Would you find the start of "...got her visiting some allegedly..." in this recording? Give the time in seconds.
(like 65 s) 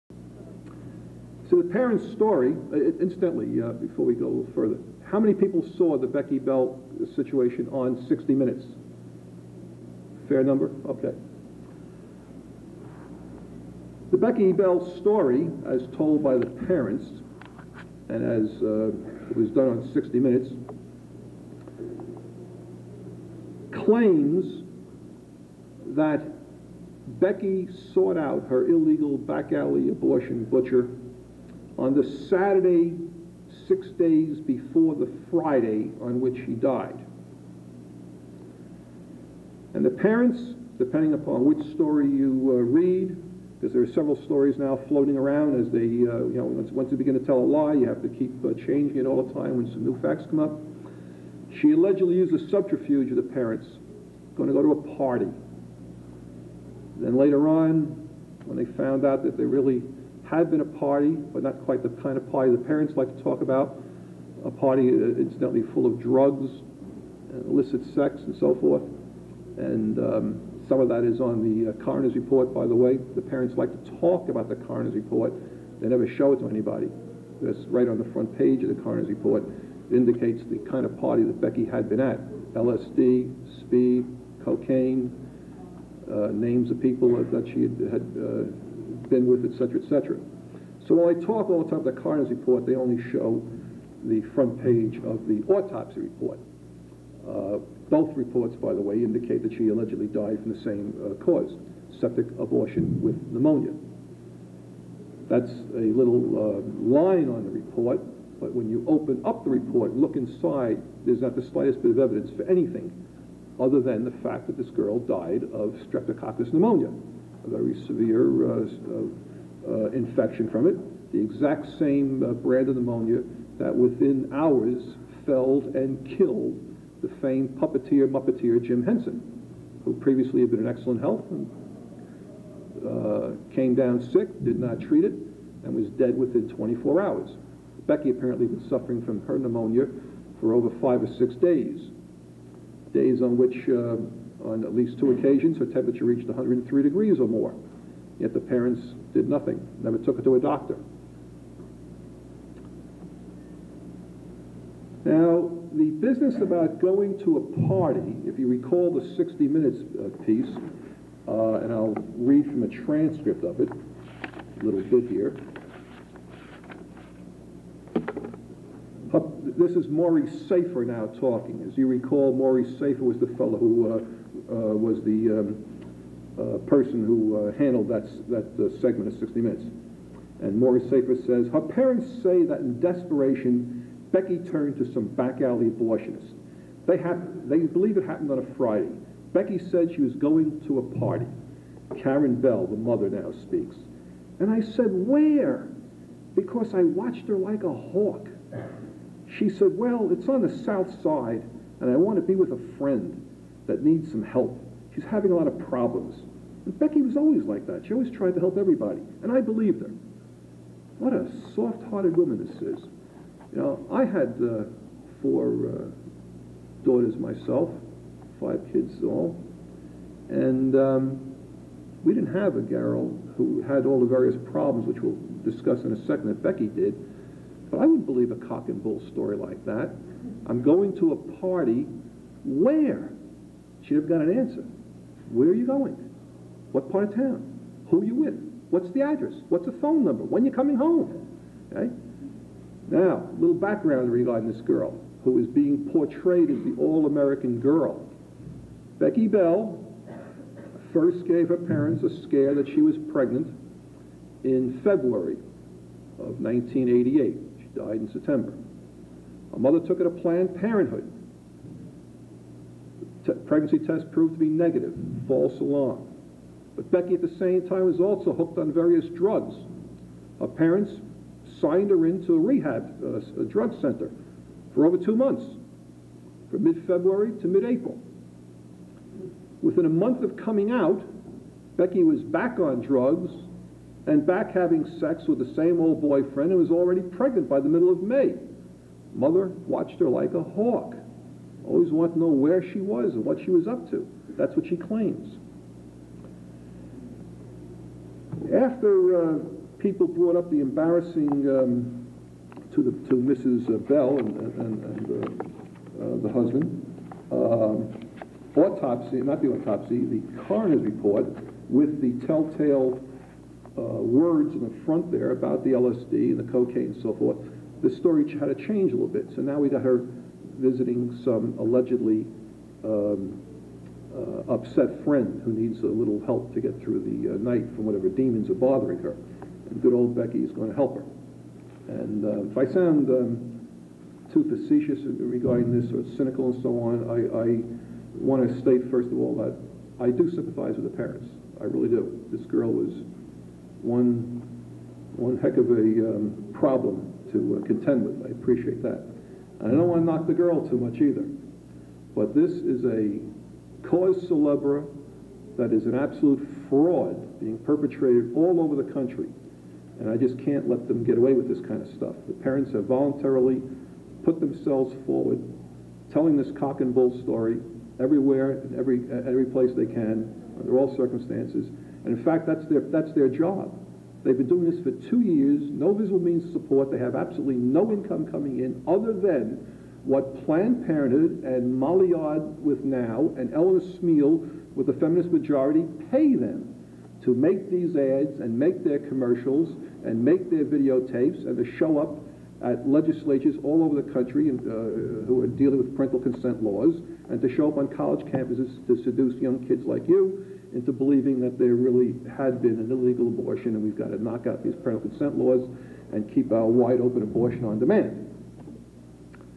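319 s.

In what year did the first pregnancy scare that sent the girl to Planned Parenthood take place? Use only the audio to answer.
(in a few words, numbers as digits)
1988.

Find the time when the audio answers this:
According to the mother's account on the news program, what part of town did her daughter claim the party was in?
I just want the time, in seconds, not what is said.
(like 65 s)
200 s.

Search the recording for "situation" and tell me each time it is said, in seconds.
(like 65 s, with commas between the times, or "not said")
7 s.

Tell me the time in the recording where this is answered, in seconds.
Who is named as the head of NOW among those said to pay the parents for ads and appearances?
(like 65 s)
381 s.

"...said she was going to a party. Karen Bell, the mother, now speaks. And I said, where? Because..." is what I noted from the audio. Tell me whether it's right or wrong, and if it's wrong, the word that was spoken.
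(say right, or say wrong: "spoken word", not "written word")
right.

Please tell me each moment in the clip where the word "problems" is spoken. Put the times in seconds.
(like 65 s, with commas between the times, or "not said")
205 s, 224 s, 346 s.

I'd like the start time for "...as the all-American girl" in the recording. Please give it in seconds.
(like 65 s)
246 s.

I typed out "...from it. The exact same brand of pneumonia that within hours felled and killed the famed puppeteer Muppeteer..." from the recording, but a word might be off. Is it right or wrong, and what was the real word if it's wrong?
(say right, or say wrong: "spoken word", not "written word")
right.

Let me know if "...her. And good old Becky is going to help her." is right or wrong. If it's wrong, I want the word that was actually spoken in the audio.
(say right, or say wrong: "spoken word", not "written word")
right.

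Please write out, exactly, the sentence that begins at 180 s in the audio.
And Morley Safer says, her parents say that in desperation, Becky turned to some back alley abortionist.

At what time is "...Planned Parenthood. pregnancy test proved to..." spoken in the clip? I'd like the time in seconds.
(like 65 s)
260 s.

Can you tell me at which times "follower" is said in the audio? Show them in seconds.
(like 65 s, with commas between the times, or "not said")
not said.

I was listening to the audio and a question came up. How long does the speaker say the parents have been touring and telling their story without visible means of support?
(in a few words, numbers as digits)
2 years.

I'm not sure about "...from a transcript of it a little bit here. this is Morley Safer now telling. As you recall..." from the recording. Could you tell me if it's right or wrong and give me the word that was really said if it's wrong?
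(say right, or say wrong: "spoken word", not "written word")
wrong: "talking", not "telling".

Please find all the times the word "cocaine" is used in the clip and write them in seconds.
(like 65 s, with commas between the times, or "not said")
84 s, 316 s.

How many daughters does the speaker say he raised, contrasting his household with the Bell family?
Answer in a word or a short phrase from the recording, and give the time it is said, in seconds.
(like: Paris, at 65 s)
4, at 215 s.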